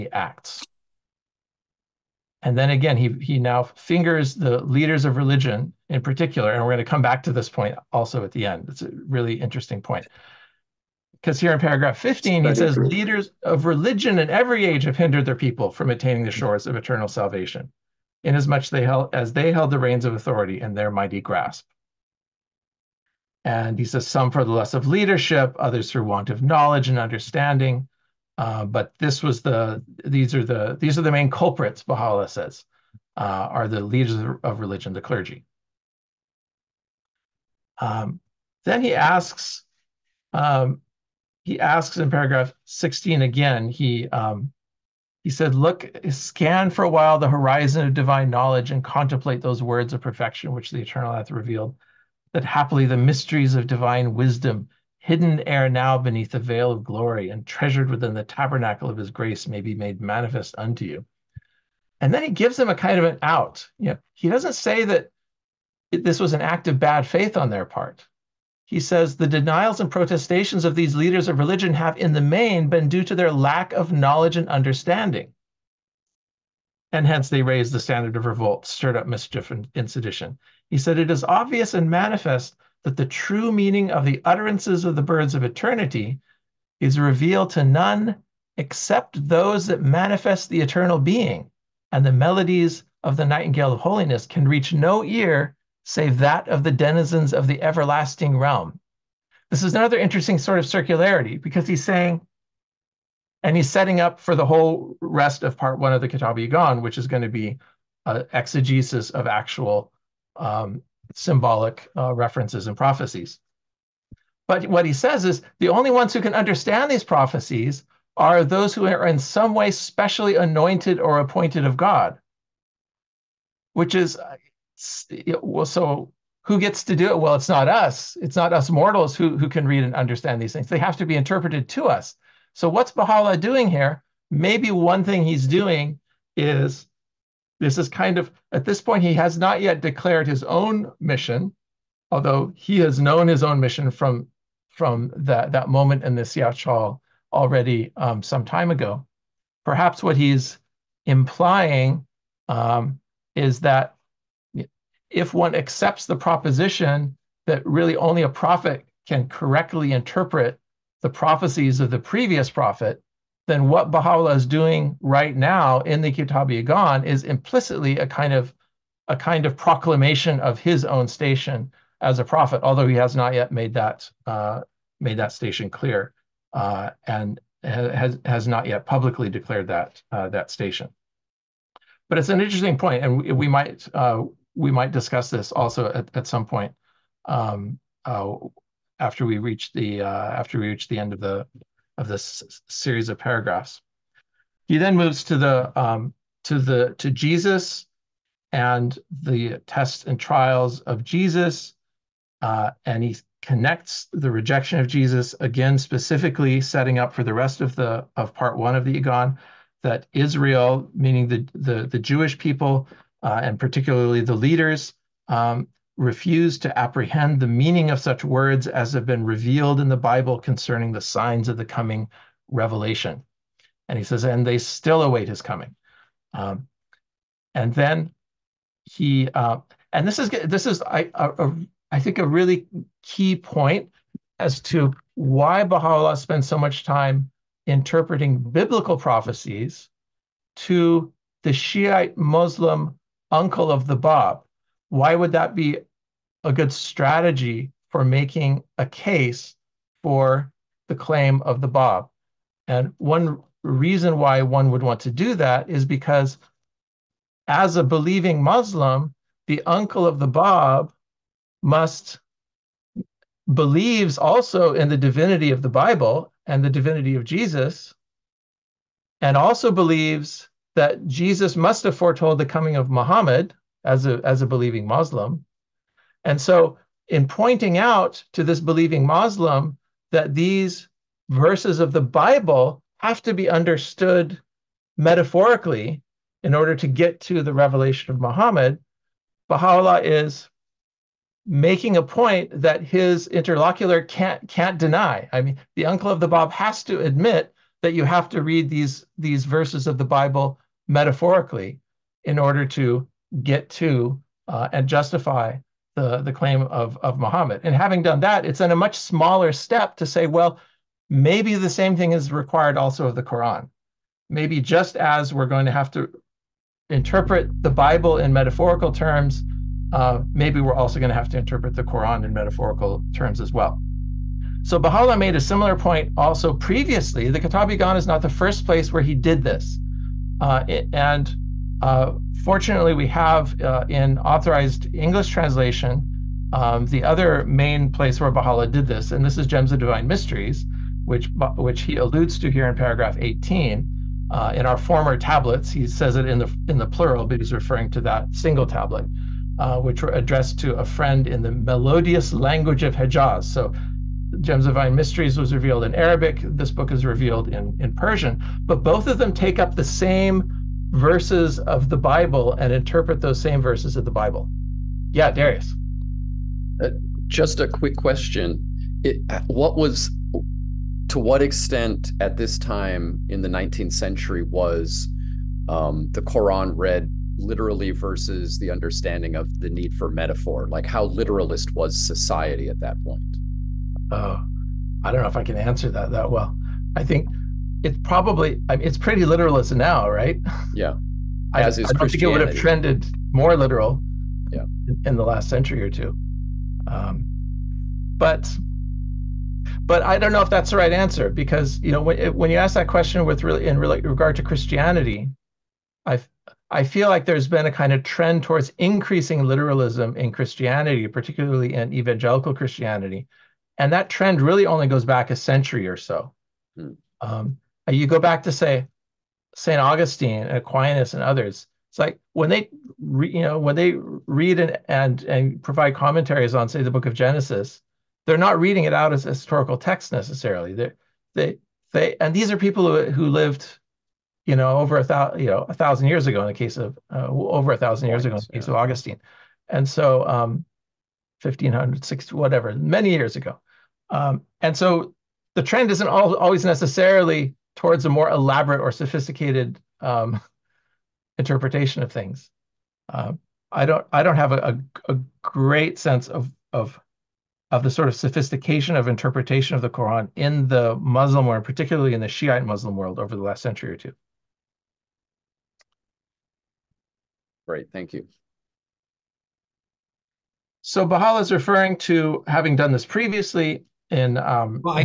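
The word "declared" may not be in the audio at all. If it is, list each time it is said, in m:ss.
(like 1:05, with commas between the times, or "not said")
2:19, 2:59.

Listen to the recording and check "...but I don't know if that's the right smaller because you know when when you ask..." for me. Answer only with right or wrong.
wrong.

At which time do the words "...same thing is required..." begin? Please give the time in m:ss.
5:11.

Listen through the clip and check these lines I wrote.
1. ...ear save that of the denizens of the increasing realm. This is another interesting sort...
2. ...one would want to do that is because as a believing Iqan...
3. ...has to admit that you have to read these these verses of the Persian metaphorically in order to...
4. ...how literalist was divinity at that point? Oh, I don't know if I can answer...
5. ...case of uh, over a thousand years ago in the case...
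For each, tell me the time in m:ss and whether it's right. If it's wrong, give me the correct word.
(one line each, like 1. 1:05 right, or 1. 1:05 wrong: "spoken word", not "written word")
1. 1:35 wrong: "everlasting", not "increasing"
2. 4:14 wrong: "Muslim", not "Iqan"
3. 4:56 wrong: "Bible", not "Persian"
4. 6:20 wrong: "society", not "divinity"
5. 7:16 right.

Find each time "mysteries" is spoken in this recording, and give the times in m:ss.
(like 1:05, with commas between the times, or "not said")
0:52, 5:40, 5:54.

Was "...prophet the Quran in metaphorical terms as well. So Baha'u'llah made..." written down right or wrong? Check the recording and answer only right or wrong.
wrong.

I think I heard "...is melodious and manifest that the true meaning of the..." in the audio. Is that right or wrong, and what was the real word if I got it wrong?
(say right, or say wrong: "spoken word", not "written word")
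wrong: "obvious", not "melodious".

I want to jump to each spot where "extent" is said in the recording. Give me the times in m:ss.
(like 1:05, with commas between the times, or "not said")
6:11.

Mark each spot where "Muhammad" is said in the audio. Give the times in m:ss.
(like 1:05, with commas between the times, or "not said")
4:32, 4:48, 5:07.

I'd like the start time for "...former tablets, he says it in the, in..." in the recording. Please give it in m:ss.
5:44.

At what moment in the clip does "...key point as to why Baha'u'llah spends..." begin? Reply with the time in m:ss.
3:53.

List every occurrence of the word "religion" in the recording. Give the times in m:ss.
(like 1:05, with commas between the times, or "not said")
0:05, 0:13, 0:34, 1:11.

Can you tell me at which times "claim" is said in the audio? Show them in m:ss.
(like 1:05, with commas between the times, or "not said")
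4:10, 5:06.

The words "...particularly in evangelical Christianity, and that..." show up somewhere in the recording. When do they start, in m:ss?
6:51.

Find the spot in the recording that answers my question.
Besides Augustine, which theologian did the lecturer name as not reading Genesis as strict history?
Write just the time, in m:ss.
7:00.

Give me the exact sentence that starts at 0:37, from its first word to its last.
Um, then he asks, um, he asks in paragraph 16 again.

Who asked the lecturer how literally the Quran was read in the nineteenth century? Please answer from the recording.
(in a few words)
Darius.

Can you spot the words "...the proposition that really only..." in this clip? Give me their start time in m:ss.
2:36.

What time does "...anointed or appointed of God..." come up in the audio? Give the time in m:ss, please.
2:00.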